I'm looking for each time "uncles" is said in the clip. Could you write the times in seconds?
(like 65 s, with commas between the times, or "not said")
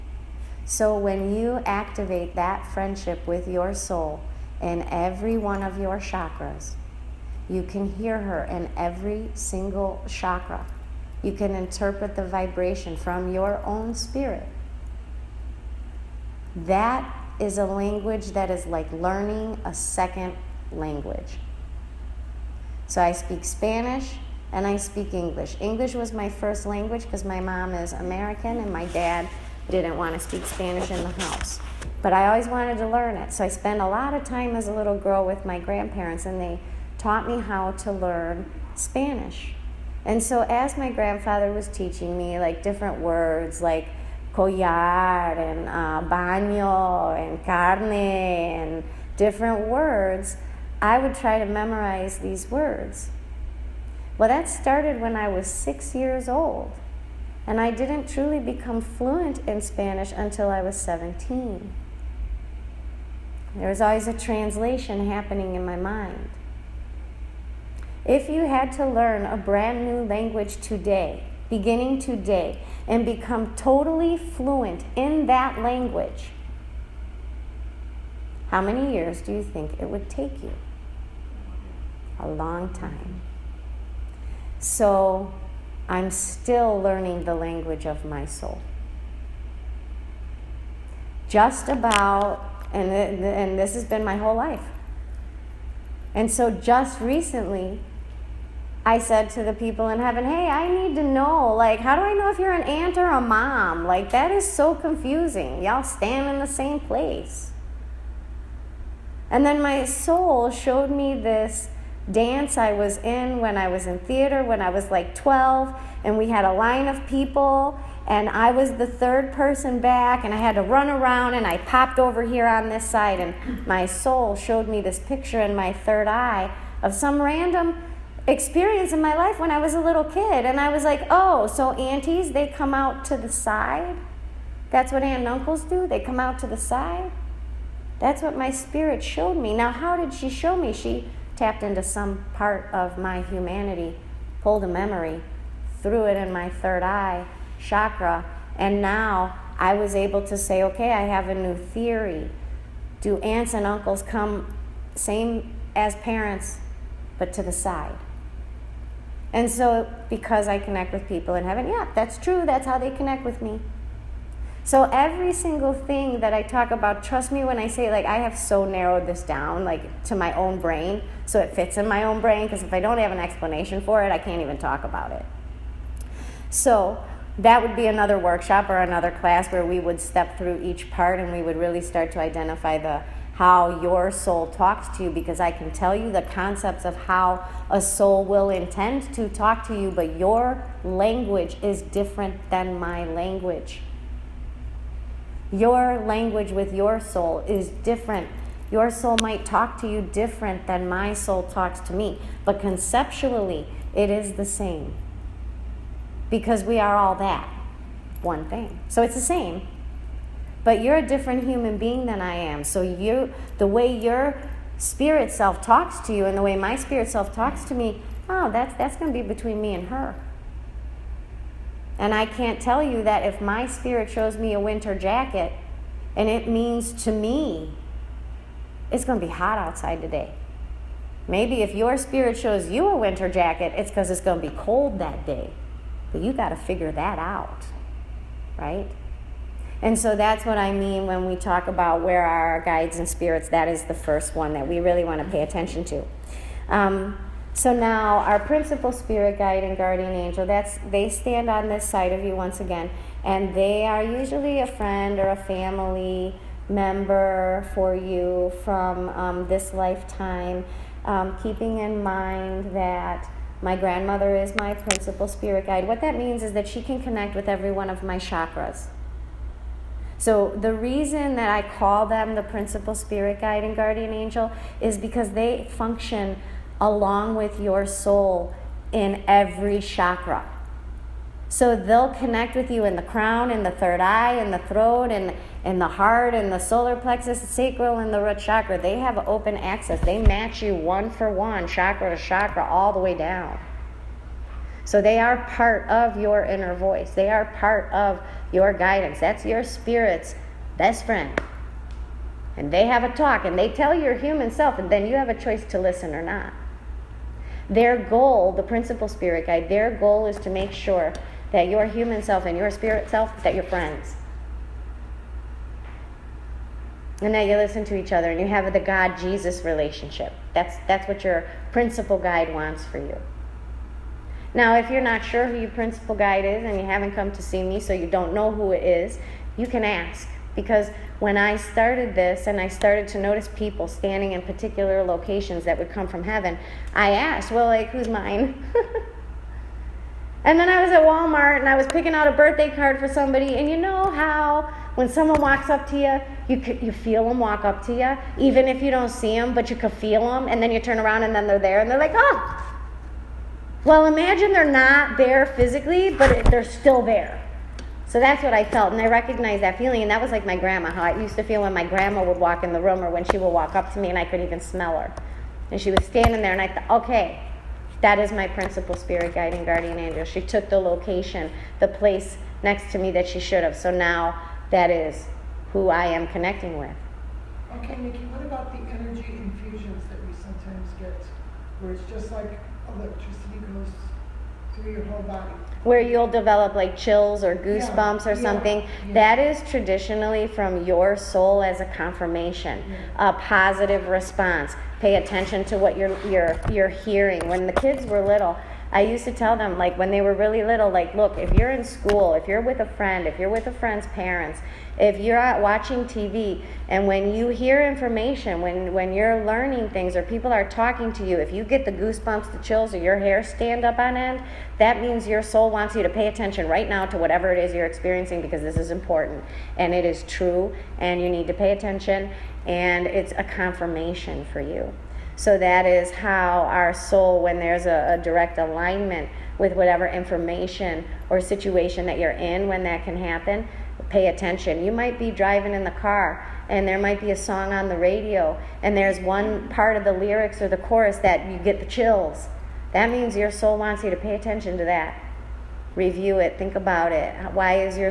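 135 s, 153 s.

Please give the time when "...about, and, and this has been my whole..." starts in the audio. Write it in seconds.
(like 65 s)
91 s.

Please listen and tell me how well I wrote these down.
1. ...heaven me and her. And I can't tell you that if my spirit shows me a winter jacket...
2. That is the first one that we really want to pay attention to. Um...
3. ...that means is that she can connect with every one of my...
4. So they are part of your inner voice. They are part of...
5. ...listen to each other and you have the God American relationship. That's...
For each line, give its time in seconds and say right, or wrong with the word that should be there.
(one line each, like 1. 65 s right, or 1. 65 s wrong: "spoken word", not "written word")
1. 219 s wrong: "between", not "heaven"
2. 243 s right
3. 265 s right
4. 294 s right
5. 317 s wrong: "Jesus", not "American".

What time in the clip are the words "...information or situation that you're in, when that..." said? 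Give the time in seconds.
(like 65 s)
430 s.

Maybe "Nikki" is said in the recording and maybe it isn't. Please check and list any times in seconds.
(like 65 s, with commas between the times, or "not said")
377 s.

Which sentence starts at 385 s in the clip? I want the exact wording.
Where you'll develop like chills or goosebumps yeah, or something.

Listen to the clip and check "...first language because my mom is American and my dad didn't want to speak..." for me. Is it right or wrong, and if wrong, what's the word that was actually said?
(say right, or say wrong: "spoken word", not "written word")
right.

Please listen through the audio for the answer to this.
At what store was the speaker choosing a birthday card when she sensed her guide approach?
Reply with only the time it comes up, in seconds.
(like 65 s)
341 s.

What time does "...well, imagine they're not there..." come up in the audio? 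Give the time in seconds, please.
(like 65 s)
353 s.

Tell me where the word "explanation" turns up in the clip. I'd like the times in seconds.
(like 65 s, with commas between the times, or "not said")
173 s.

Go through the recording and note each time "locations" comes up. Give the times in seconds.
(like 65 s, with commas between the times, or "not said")
335 s, 370 s.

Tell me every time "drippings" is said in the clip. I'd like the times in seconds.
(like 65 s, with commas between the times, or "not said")
not said.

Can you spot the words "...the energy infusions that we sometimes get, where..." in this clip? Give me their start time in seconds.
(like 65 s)
378 s.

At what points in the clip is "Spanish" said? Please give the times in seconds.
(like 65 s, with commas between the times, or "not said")
23 s, 30 s, 38 s, 59 s.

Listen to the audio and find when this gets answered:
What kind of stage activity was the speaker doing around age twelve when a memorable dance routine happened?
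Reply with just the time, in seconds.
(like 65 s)
113 s.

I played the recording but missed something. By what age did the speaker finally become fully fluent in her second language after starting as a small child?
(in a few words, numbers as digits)
17.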